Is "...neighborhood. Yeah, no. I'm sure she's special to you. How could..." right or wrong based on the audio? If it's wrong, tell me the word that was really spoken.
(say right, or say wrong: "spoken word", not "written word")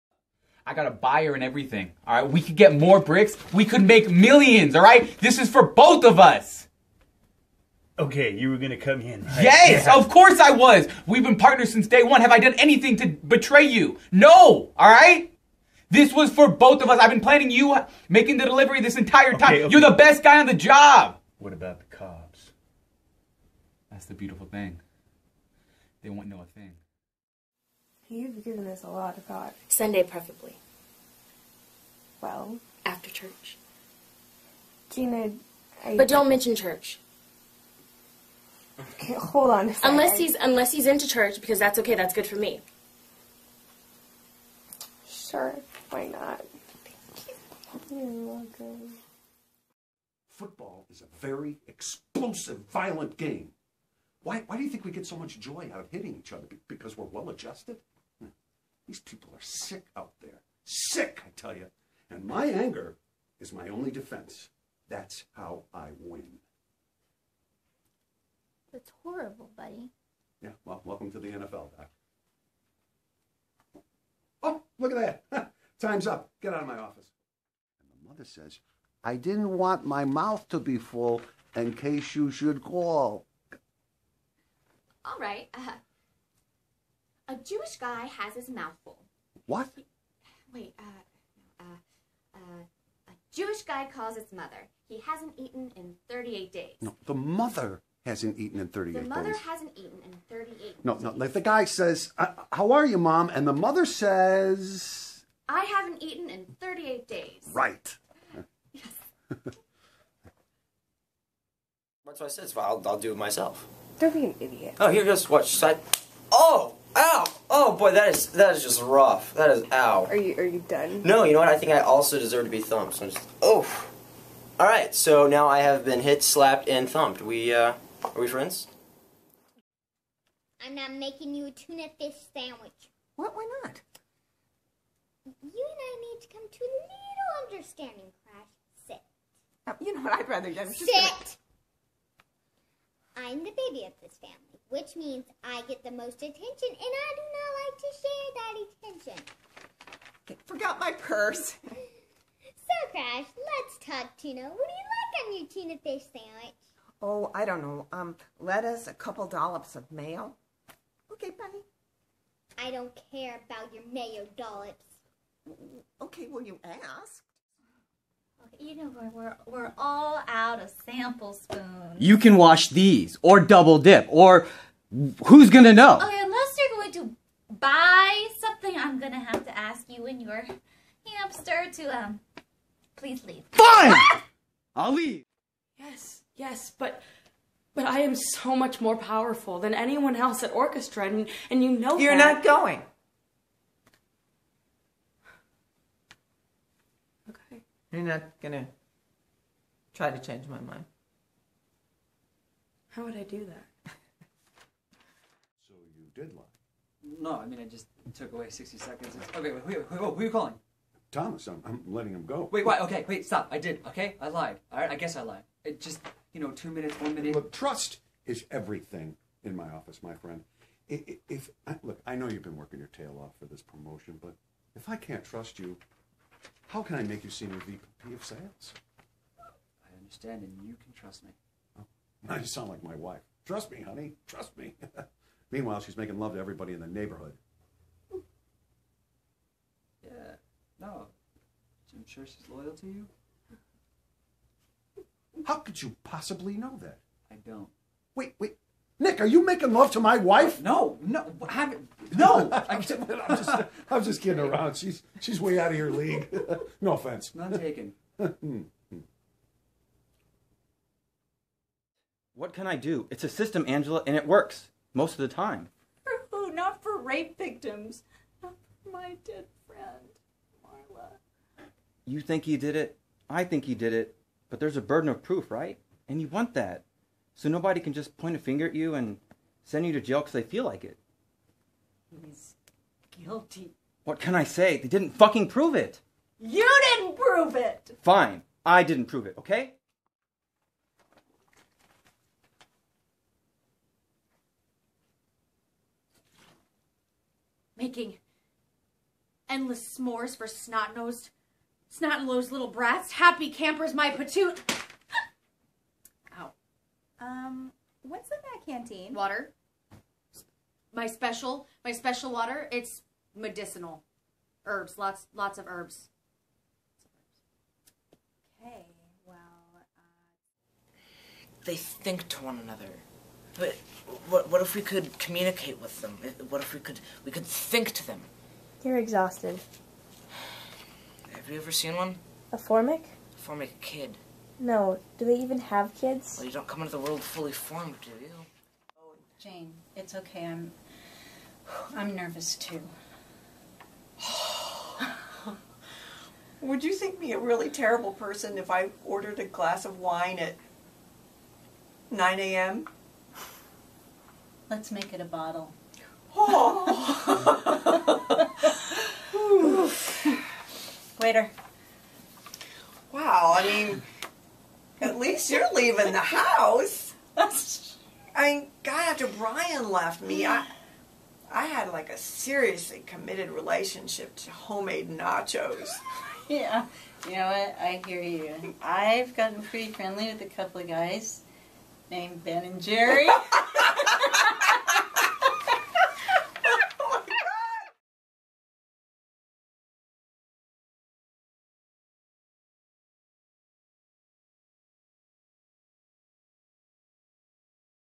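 wrong: "loyal", not "special".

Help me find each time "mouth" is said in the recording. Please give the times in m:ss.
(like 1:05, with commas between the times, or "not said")
1:20, 1:28.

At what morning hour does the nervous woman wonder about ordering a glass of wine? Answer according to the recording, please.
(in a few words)
9 a.m.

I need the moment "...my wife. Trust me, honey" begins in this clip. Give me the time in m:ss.
3:52.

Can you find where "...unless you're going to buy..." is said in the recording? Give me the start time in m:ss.
2:56.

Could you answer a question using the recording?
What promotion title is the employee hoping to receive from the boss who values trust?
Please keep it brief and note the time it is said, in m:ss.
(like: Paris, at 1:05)
senior VP of sales, at 3:47.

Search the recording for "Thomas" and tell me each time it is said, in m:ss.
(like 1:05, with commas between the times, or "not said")
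3:31.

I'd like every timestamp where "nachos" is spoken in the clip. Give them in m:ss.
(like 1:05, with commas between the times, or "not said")
6:15.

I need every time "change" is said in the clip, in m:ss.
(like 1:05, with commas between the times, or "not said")
3:20.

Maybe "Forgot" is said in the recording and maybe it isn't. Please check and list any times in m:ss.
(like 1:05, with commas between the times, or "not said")
2:30.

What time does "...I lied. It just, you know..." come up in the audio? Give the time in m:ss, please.
3:35.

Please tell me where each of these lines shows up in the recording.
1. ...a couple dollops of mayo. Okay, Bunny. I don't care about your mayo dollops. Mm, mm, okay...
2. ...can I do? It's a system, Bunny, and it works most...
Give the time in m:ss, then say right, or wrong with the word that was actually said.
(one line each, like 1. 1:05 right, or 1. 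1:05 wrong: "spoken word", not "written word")
1. 2:38 right
2. 4:22 wrong: "Angela", not "Bunny".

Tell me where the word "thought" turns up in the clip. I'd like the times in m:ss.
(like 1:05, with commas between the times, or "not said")
0:29.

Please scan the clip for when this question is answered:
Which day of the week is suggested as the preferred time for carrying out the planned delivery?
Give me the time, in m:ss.
0:29.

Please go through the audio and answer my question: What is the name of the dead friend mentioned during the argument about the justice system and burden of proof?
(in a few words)
Marla.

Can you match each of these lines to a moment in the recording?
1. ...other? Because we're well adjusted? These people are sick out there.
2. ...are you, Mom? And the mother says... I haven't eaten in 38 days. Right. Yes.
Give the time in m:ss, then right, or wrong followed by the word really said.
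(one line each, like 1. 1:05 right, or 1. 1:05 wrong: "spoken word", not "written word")
1. 0:56 right
2. 1:42 right.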